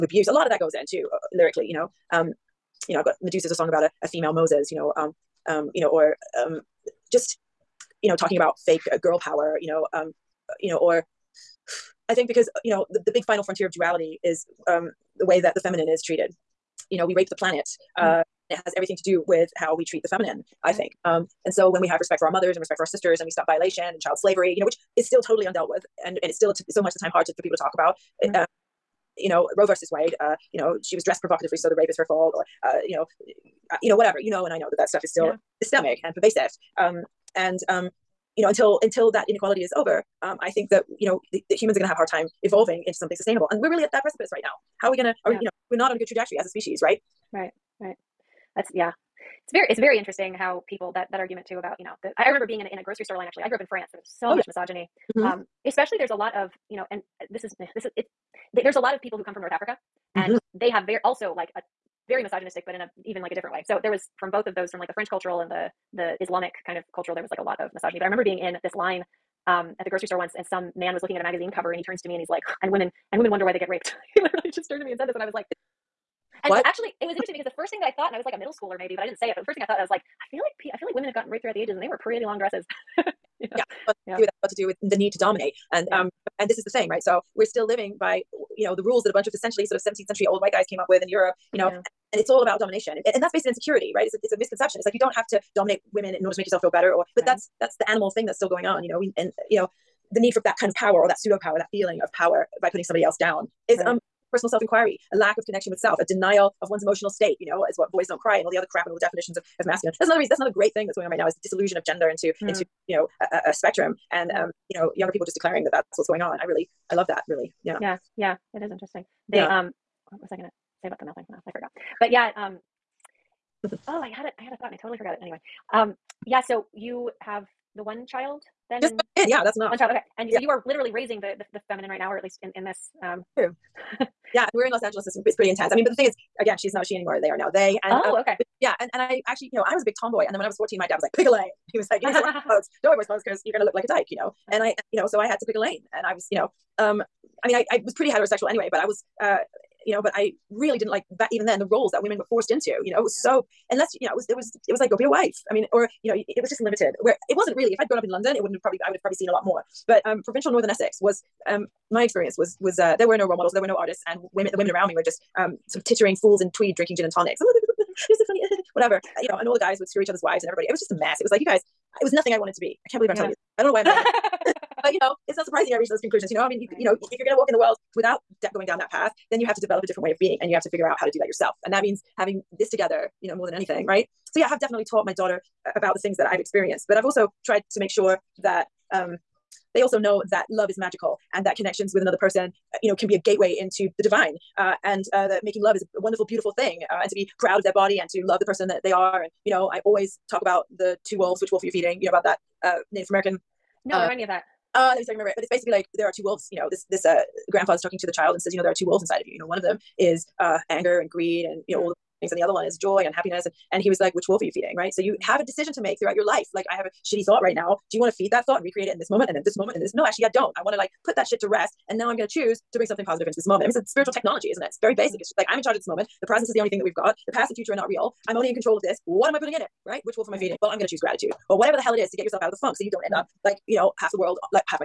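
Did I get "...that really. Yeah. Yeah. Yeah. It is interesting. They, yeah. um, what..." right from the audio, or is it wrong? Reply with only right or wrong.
right.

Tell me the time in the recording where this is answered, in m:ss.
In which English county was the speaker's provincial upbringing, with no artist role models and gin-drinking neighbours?
2:40.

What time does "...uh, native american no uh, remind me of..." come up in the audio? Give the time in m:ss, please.
3:22.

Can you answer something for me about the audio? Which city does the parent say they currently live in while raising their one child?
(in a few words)
Los Angeles.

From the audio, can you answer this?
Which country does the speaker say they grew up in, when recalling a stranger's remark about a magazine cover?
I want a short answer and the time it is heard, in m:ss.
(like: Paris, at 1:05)
France, at 0:53.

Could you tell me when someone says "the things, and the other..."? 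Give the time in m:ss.
3:31.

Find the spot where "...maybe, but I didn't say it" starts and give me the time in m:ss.
1:18.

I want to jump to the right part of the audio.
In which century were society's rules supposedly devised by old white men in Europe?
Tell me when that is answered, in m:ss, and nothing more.
1:29.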